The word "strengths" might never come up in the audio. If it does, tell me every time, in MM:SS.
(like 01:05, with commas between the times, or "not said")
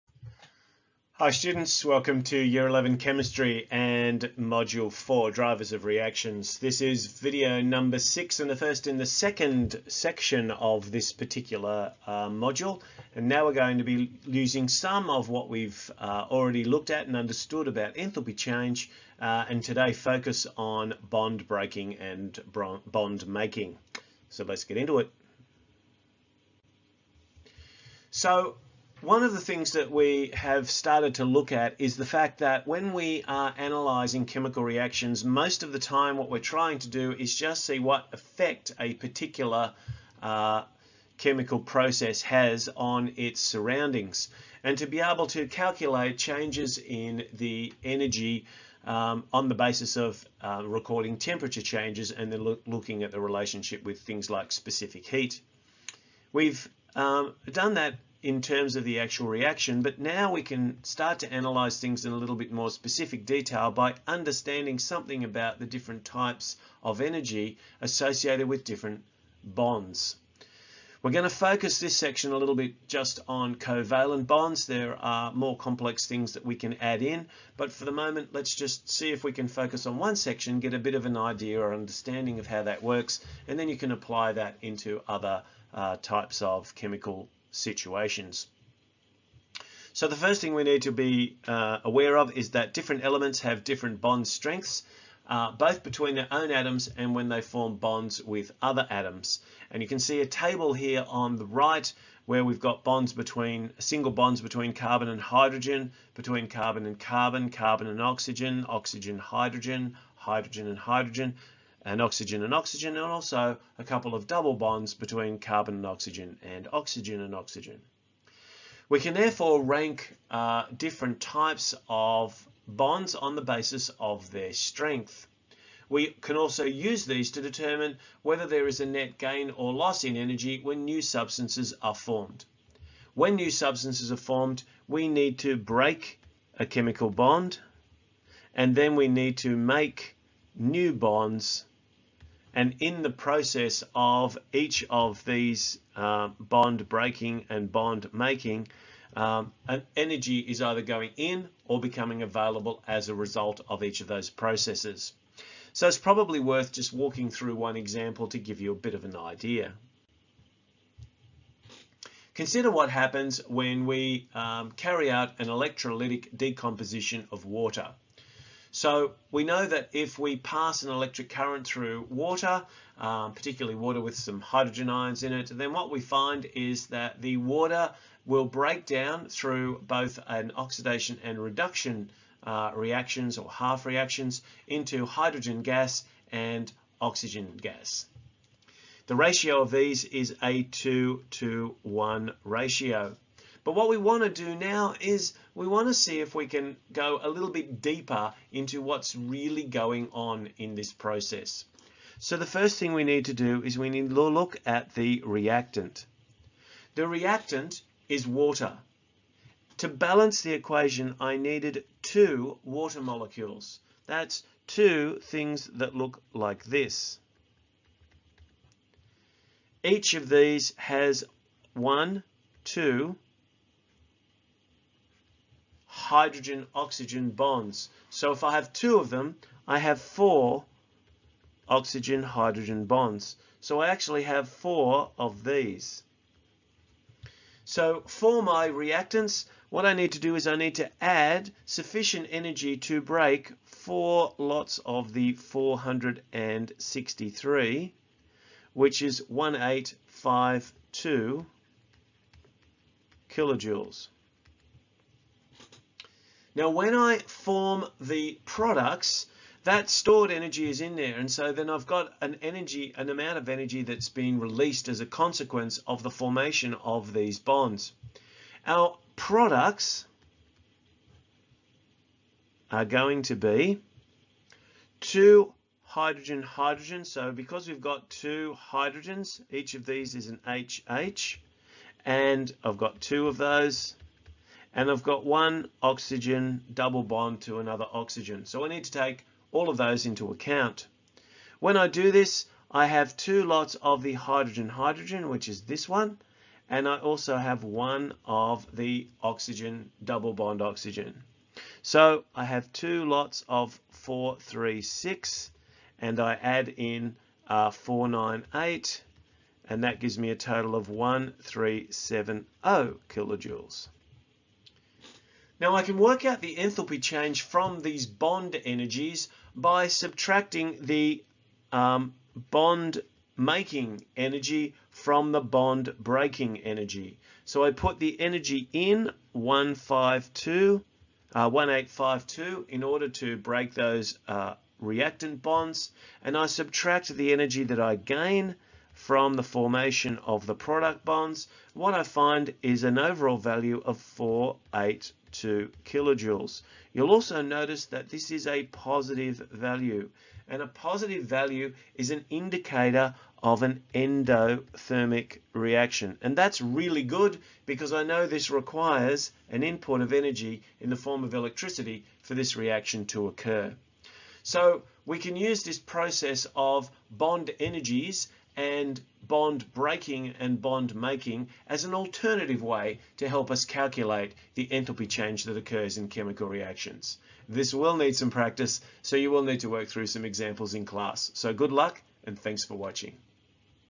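01:34, 02:04.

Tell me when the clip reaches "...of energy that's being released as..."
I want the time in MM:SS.
04:23.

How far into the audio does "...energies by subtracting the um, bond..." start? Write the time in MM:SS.
05:18.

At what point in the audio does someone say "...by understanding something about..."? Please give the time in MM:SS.
01:03.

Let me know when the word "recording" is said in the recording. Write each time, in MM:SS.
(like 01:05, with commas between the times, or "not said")
00:50.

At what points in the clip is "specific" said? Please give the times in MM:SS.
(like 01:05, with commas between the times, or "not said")
00:54, 01:02.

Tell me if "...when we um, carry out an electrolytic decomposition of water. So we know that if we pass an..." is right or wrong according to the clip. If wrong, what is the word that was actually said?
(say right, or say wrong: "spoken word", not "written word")
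right.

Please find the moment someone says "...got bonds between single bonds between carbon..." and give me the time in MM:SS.
01:42.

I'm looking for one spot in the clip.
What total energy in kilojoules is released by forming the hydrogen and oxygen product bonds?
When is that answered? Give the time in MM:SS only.
05:10.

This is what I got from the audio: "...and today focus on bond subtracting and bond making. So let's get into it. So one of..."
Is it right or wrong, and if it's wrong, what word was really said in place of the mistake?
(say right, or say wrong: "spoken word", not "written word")
wrong: "breaking", not "subtracting".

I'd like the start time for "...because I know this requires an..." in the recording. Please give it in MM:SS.
05:57.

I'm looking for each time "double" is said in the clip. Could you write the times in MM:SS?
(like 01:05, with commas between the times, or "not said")
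01:54, 04:46, 05:00.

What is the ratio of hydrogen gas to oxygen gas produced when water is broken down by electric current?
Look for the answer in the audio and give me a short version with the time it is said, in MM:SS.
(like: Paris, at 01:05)
2 to 1, at 03:10.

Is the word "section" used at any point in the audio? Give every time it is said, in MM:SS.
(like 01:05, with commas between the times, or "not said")
00:09, 01:11, 01:20.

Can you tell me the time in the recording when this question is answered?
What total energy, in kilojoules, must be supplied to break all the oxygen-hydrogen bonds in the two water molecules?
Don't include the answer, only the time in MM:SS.
04:09.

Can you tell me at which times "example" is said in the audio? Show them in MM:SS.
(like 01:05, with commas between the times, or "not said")
02:37, 06:20.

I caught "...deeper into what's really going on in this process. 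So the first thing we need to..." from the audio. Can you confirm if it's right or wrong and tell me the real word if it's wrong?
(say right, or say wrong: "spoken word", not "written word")
right.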